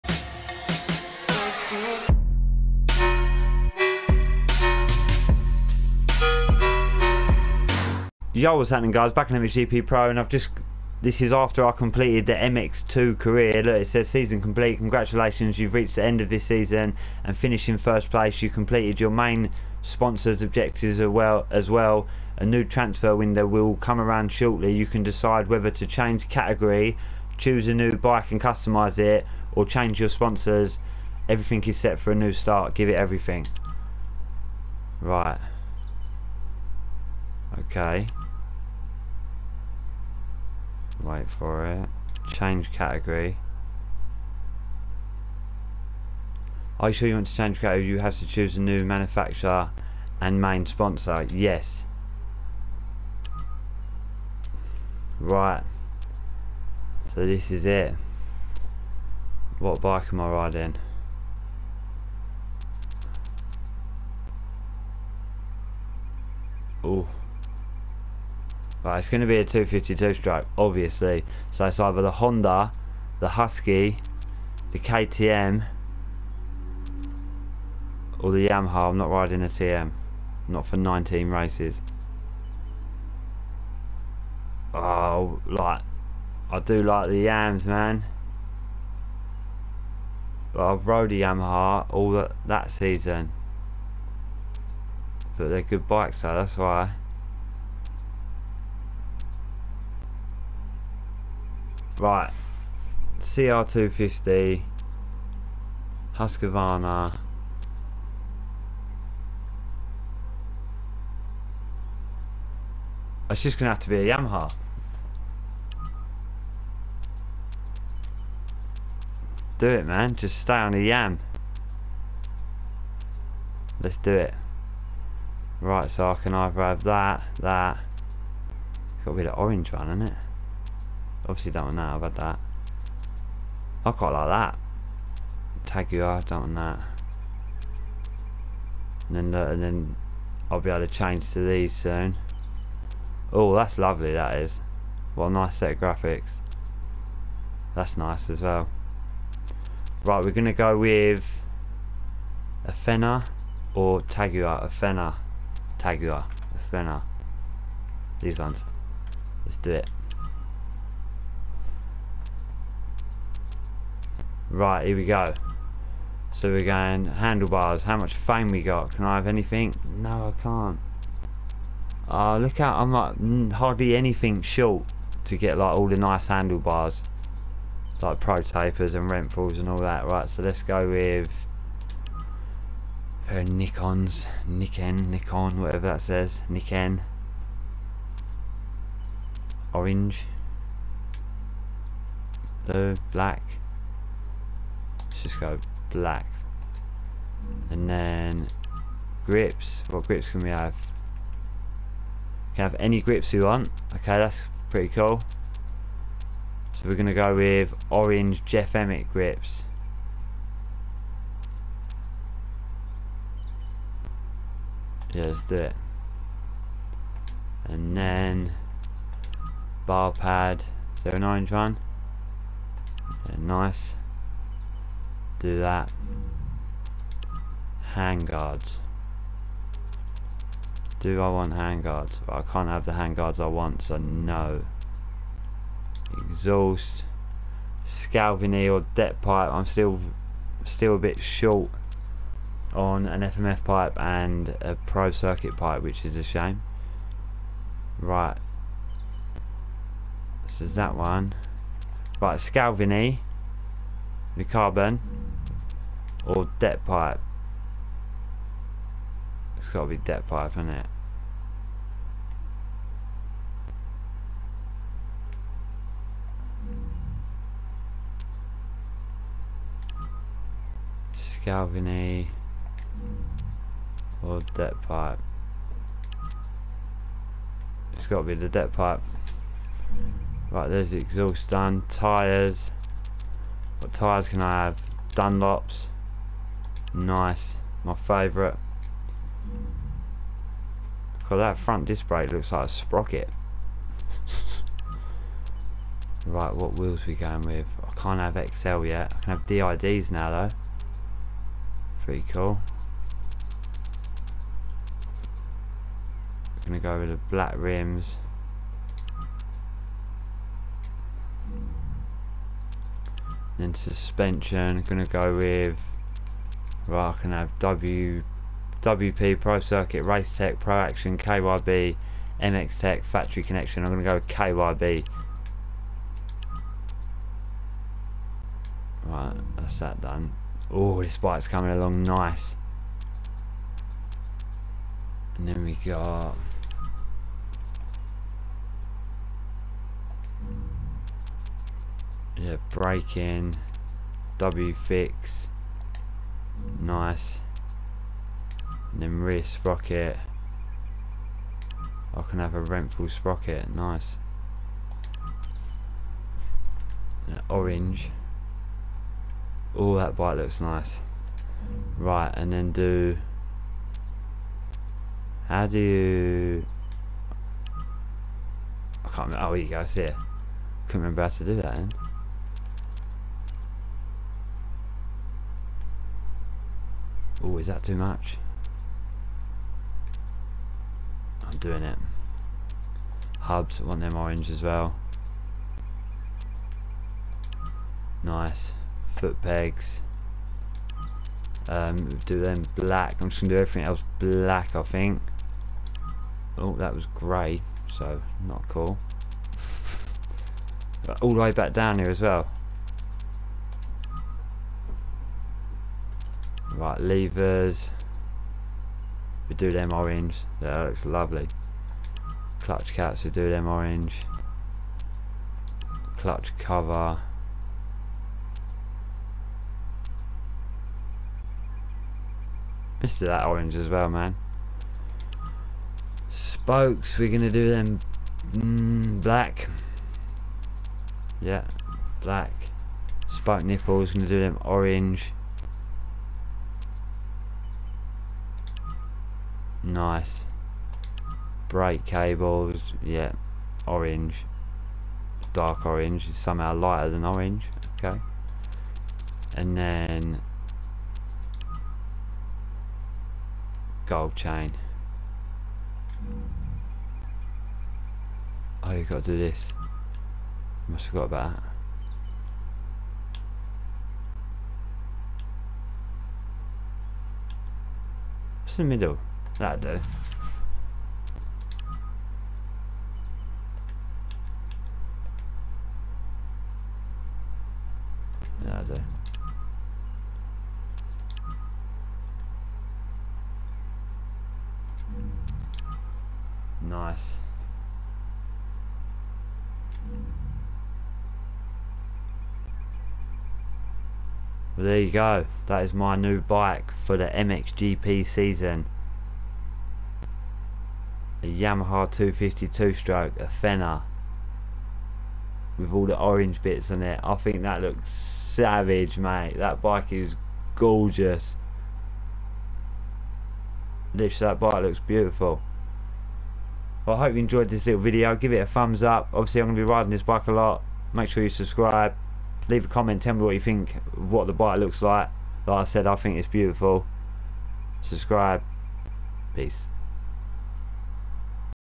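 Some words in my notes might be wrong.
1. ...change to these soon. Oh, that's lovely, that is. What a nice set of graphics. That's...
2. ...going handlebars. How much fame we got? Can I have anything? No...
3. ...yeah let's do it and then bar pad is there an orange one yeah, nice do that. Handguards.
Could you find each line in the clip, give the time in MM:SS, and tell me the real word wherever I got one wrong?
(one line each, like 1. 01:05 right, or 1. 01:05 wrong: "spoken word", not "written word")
1. 02:20 right
2. 02:46 right
3. 03:35 right.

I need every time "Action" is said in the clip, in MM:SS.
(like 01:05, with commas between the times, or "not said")
05:20.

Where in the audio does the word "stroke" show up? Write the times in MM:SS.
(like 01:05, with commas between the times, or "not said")
01:10, 08:22.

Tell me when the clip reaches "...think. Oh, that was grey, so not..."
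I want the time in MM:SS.
06:34.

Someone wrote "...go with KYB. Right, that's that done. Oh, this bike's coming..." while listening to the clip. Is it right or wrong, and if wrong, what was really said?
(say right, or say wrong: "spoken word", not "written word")
right.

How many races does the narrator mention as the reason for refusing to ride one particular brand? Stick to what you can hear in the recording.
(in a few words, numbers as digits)
19.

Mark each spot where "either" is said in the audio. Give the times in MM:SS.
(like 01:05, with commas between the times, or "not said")
01:11, 02:06.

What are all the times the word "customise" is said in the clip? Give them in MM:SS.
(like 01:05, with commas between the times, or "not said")
00:28.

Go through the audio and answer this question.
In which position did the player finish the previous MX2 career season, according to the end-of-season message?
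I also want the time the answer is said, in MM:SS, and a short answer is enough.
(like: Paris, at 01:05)
First place, at 00:17.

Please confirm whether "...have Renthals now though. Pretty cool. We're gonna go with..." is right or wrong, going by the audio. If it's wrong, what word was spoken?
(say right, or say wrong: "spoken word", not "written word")
wrong: "DIDs", not "Renthals".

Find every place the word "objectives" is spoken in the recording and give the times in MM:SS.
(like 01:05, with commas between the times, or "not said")
00:20.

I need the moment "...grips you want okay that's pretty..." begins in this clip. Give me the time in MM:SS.
03:23.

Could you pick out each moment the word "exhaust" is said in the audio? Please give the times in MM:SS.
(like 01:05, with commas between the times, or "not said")
03:56, 04:40.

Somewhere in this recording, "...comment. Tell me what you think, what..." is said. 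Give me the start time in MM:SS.
08:42.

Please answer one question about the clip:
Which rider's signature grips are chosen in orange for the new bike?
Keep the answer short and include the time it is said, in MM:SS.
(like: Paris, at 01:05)
Jeff Emig, at 03:28.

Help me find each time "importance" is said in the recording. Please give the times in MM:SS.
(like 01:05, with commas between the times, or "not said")
not said.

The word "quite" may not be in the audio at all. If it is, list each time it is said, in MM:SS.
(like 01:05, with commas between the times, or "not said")
02:13.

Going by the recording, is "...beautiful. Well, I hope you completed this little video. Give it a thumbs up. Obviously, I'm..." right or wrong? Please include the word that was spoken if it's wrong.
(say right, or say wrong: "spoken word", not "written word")
wrong: "enjoyed", not "completed".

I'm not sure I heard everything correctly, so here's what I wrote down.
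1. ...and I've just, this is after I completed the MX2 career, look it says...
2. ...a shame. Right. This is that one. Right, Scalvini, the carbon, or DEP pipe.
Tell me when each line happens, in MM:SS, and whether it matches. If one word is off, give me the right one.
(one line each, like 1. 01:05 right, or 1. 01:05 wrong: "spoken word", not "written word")
1. 00:10 right
2. 04:06 right.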